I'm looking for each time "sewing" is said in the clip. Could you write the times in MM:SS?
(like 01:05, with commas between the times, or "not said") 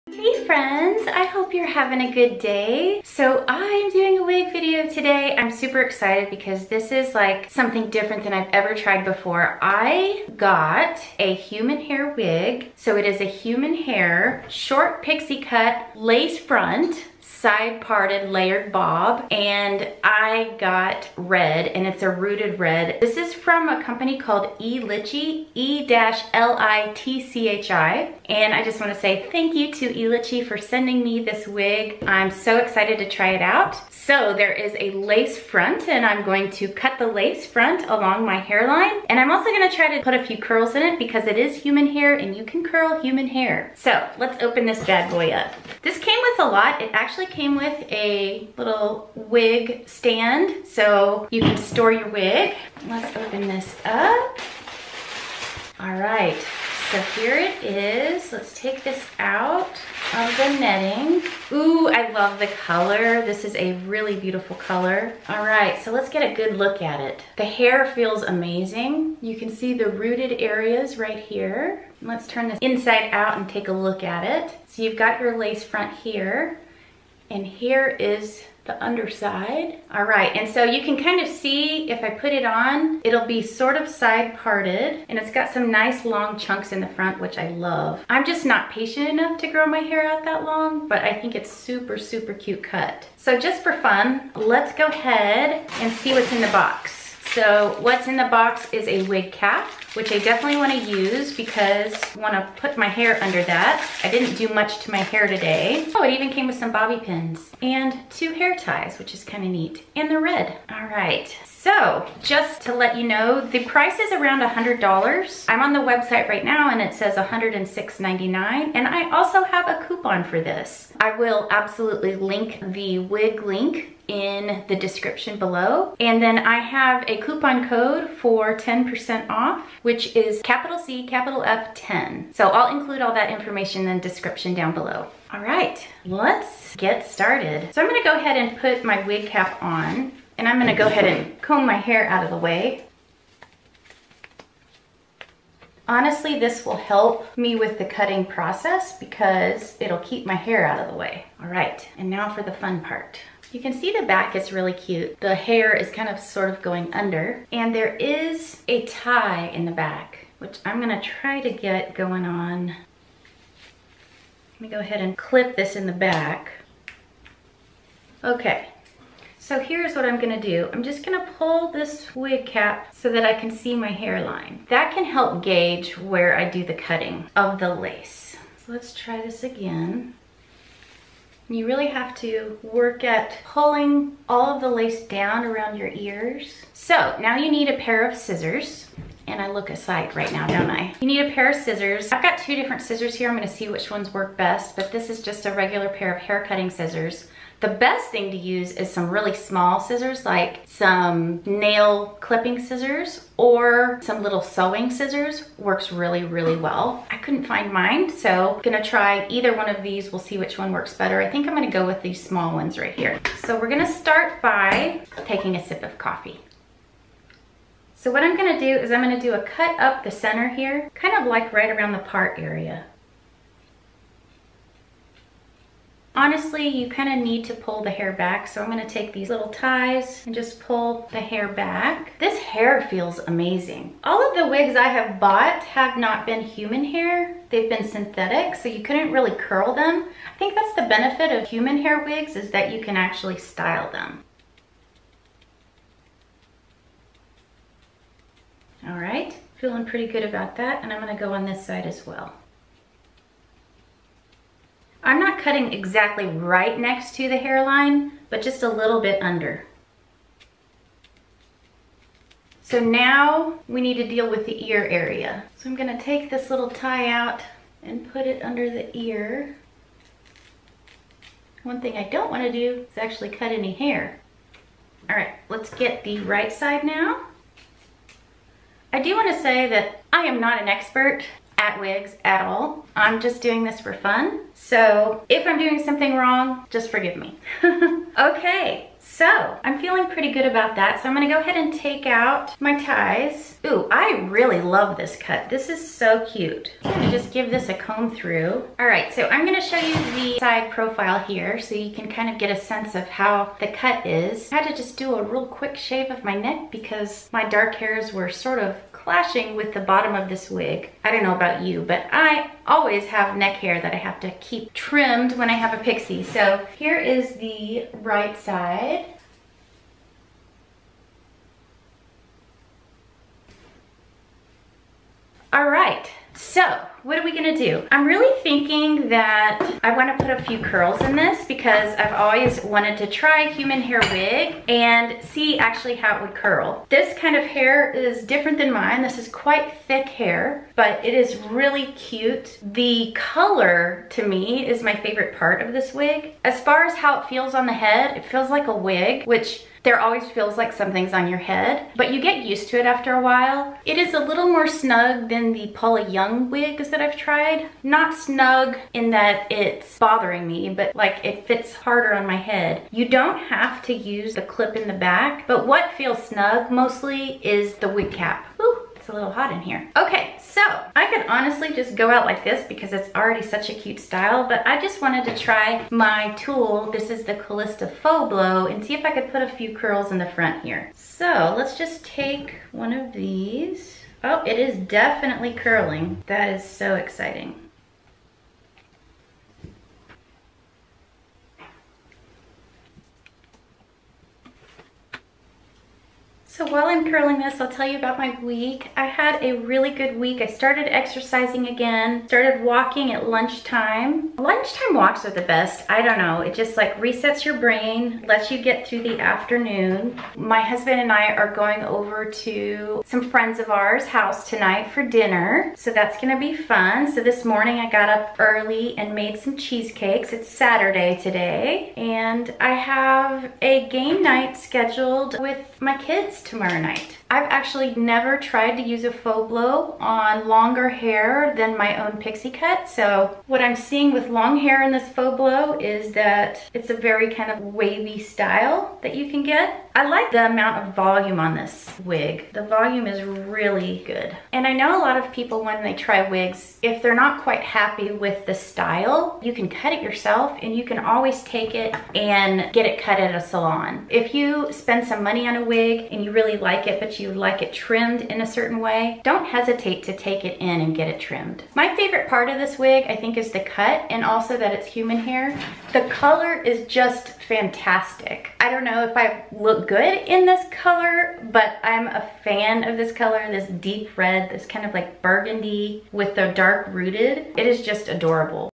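03:24.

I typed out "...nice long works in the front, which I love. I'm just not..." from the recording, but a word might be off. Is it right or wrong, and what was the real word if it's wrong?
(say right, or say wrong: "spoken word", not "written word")
wrong: "chunks", not "works".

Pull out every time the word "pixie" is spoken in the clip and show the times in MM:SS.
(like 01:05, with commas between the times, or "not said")
00:15, 05:15, 07:12.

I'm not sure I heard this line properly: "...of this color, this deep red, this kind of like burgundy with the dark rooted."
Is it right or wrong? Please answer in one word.
right.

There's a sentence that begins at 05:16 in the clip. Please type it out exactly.
So here is the right side.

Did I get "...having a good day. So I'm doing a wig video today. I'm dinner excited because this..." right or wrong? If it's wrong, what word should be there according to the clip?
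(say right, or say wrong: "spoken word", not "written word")
wrong: "super", not "dinner".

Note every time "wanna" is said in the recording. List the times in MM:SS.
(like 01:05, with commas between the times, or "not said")
00:28, 04:32, 04:39, 05:29.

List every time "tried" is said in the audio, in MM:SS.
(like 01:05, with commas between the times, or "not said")
00:08, 05:57, 07:08.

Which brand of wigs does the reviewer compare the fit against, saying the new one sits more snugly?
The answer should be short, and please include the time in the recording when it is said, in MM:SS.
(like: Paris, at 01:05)
Paula Young, at 05:55.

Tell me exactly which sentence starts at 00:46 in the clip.
It actually came with a little wig stand so you can store your wig.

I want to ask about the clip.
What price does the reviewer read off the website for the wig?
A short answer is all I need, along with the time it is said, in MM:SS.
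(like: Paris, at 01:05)
$106.99, at 01:57.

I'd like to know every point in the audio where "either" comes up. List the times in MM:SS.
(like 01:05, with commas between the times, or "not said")
03:29.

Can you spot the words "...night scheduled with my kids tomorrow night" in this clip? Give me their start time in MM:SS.
07:04.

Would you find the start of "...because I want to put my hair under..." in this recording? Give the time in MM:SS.
01:41.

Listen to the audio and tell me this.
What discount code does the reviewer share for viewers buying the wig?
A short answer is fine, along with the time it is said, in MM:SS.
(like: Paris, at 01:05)
CF10, at 02:10.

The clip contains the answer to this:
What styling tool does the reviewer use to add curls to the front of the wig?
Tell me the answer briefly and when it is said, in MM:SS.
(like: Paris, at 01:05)
Calista Faux Blow, at 06:17.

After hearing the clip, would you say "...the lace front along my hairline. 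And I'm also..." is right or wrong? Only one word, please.
right.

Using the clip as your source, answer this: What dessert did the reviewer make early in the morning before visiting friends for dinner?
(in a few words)
cheesecakes.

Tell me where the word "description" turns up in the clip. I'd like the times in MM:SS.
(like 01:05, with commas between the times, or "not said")
02:04, 02:14.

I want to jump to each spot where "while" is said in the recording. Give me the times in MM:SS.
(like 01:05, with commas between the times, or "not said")
05:53, 06:36.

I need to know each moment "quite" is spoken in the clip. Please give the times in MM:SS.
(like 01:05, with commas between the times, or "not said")
05:39, 07:27.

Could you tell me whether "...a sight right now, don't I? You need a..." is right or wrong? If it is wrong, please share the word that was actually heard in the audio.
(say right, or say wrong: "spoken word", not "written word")
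right.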